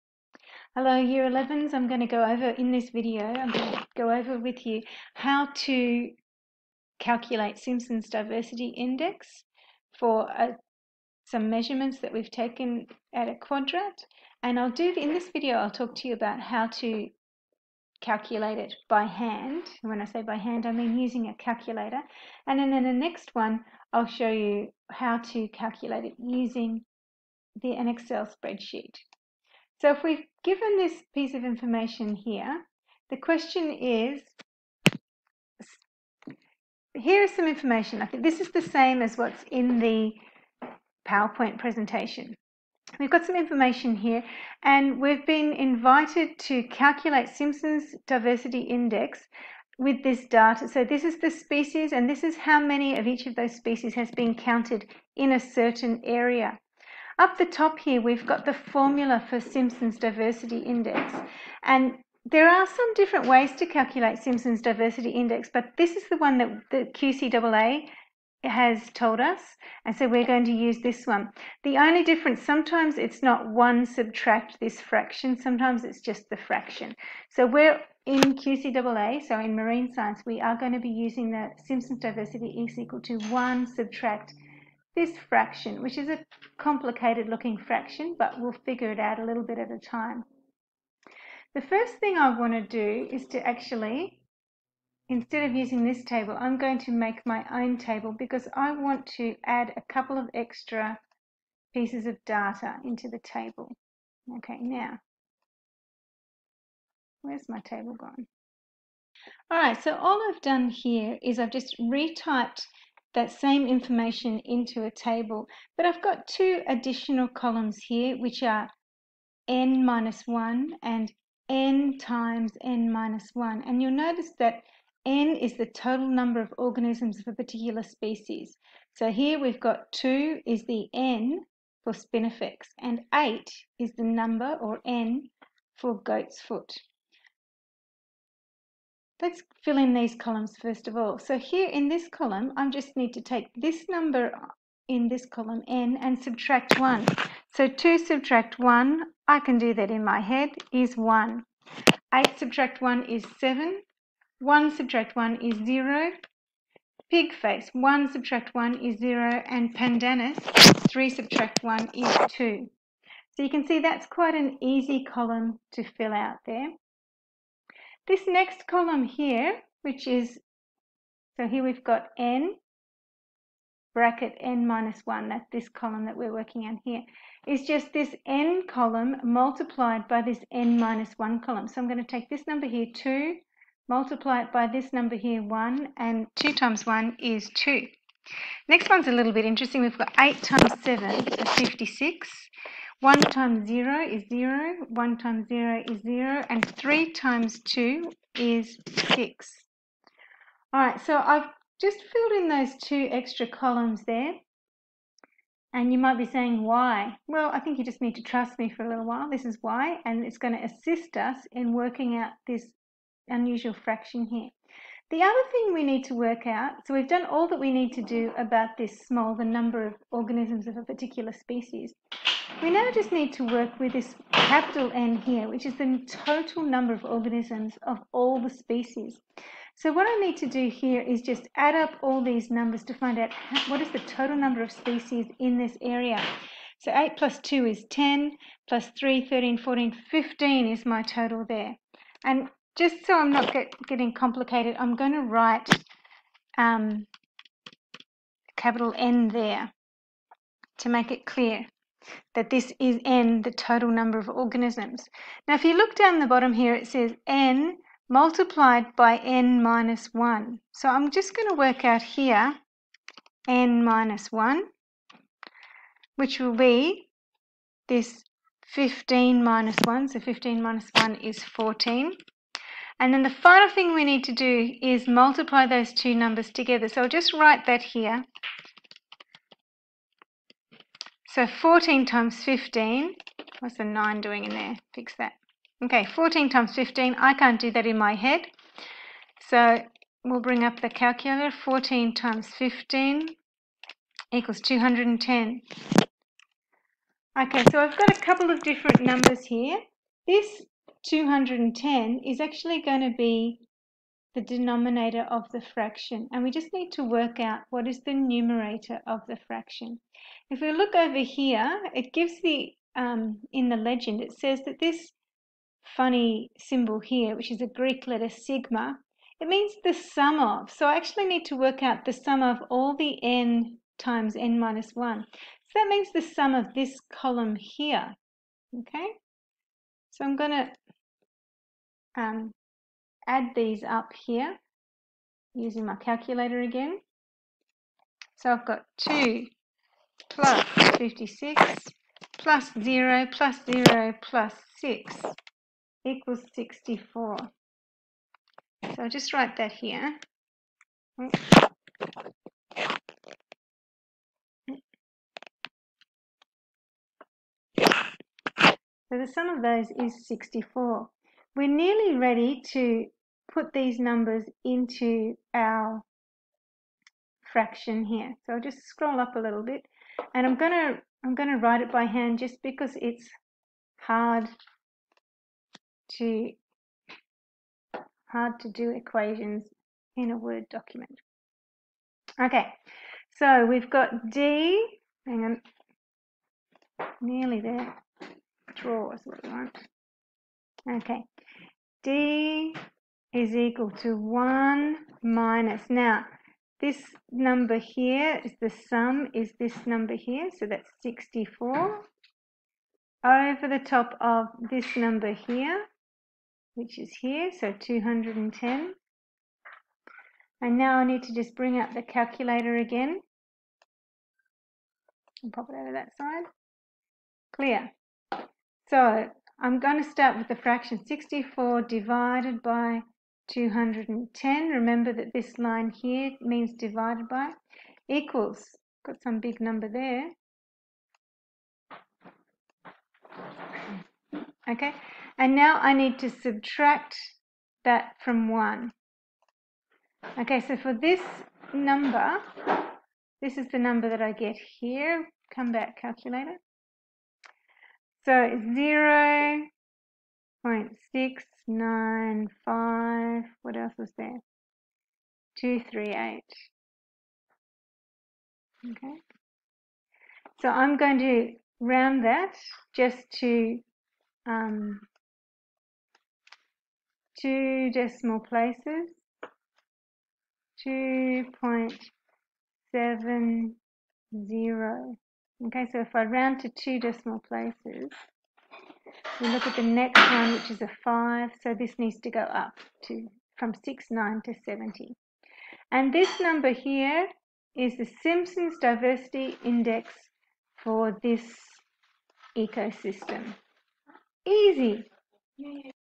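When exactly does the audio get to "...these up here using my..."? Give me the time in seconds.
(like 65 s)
333 s.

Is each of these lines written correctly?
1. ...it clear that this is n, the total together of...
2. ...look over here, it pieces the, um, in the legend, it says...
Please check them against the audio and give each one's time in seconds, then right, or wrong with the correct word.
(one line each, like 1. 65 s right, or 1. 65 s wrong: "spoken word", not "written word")
1. 251 s wrong: "number", not "together"
2. 310 s wrong: "gives", not "pieces".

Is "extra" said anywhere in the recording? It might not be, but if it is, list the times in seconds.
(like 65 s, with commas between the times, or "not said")
100 s, 203 s.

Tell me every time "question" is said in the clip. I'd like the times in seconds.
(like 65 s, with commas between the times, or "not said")
33 s.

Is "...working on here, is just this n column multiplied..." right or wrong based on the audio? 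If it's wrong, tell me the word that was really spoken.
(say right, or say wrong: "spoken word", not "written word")
right.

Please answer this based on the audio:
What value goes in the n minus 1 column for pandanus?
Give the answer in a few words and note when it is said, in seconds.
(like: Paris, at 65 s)
2, at 160 s.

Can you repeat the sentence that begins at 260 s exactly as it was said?
So I'm just going to work out here n minus 1, which will be this 15 minus 1.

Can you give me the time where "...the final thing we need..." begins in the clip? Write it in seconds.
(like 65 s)
273 s.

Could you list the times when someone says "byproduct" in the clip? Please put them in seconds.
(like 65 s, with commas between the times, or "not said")
not said.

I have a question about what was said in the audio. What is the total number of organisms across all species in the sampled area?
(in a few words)
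15.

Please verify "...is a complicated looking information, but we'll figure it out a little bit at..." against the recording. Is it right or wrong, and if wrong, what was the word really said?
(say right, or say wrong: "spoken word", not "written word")
wrong: "fraction", not "information".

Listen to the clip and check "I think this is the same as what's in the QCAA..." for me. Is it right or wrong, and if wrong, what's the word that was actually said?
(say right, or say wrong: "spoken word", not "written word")
wrong: "PowerPoint", not "QCAA".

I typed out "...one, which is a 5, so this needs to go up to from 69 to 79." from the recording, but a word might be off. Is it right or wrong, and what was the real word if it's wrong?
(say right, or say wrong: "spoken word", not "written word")
wrong: "70", not "79".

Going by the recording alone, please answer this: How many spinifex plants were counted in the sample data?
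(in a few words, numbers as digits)
2.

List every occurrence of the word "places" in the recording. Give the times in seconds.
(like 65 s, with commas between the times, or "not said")
468 s, 477 s.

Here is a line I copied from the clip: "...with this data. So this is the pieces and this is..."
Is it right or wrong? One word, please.
wrong.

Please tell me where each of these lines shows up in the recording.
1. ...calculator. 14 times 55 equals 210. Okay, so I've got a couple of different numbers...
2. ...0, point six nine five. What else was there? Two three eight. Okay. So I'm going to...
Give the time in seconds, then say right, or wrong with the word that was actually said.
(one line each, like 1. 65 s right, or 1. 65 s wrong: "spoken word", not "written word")
1. 290 s wrong: "15", not "55"
2. 448 s right.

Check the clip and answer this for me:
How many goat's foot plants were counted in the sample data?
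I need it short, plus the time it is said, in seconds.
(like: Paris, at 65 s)
8, at 133 s.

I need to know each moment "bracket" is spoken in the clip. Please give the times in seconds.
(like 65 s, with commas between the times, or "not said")
173 s.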